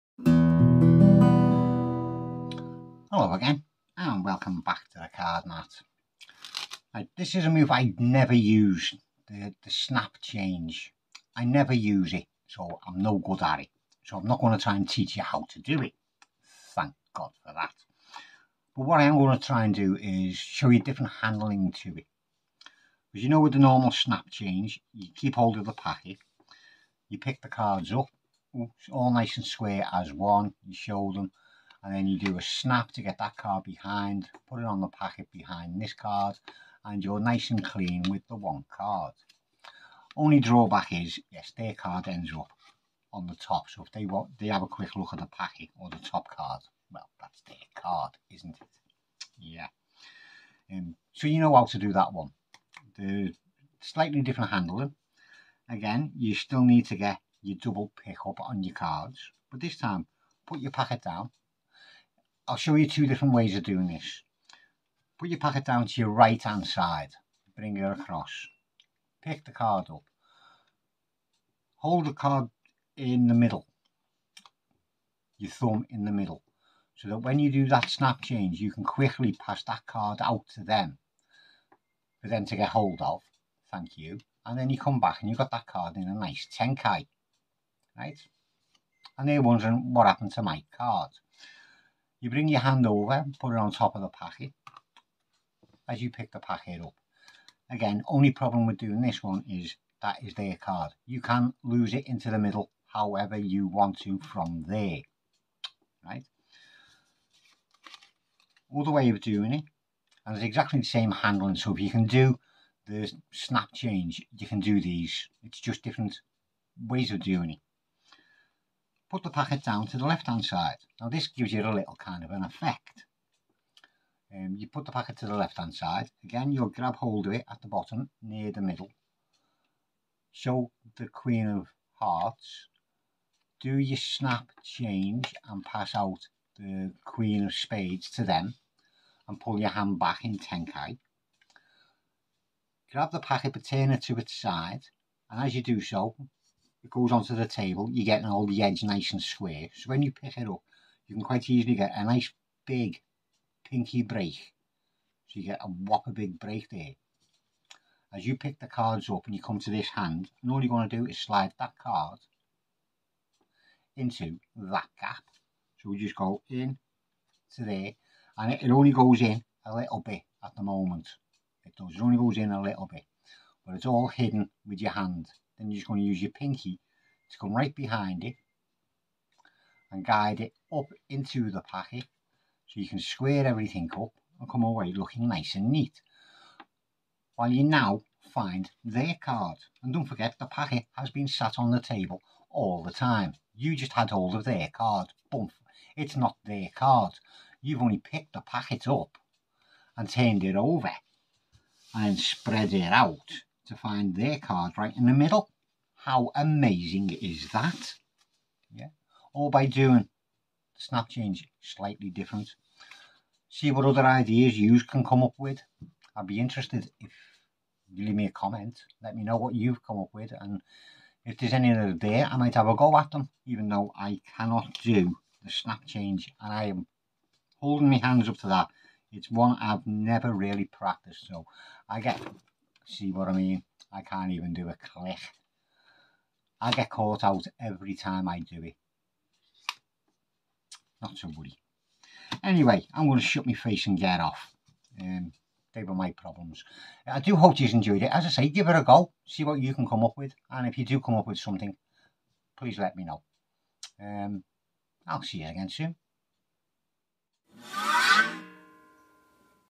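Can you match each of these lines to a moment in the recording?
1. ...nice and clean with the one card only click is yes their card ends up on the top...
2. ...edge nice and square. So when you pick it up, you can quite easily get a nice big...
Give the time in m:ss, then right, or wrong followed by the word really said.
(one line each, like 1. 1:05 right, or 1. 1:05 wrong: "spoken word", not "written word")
1. 0:37 wrong: "drawback", not "click"
2. 2:28 right.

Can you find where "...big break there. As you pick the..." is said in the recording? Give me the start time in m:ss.
2:36.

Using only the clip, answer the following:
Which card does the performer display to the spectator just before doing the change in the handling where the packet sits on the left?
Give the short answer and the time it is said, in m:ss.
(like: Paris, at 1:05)
Queen of Hearts, at 2:11.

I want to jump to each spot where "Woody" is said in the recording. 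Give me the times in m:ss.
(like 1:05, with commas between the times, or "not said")
4:01.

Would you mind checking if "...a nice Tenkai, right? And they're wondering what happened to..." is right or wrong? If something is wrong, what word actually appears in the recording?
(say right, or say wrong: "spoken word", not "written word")
right.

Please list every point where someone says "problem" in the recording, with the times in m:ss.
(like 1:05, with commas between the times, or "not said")
1:38, 4:06.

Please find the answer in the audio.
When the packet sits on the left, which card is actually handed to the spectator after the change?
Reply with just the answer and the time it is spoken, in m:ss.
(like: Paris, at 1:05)
Queen of Spades, at 2:17.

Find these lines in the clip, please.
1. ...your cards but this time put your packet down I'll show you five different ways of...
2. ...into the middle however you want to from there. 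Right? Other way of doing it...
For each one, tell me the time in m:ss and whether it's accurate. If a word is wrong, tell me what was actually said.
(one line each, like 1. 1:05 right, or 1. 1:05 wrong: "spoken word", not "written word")
1. 0:58 wrong: "two", not "five"
2. 1:42 right.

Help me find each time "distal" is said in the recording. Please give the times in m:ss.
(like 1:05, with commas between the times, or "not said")
not said.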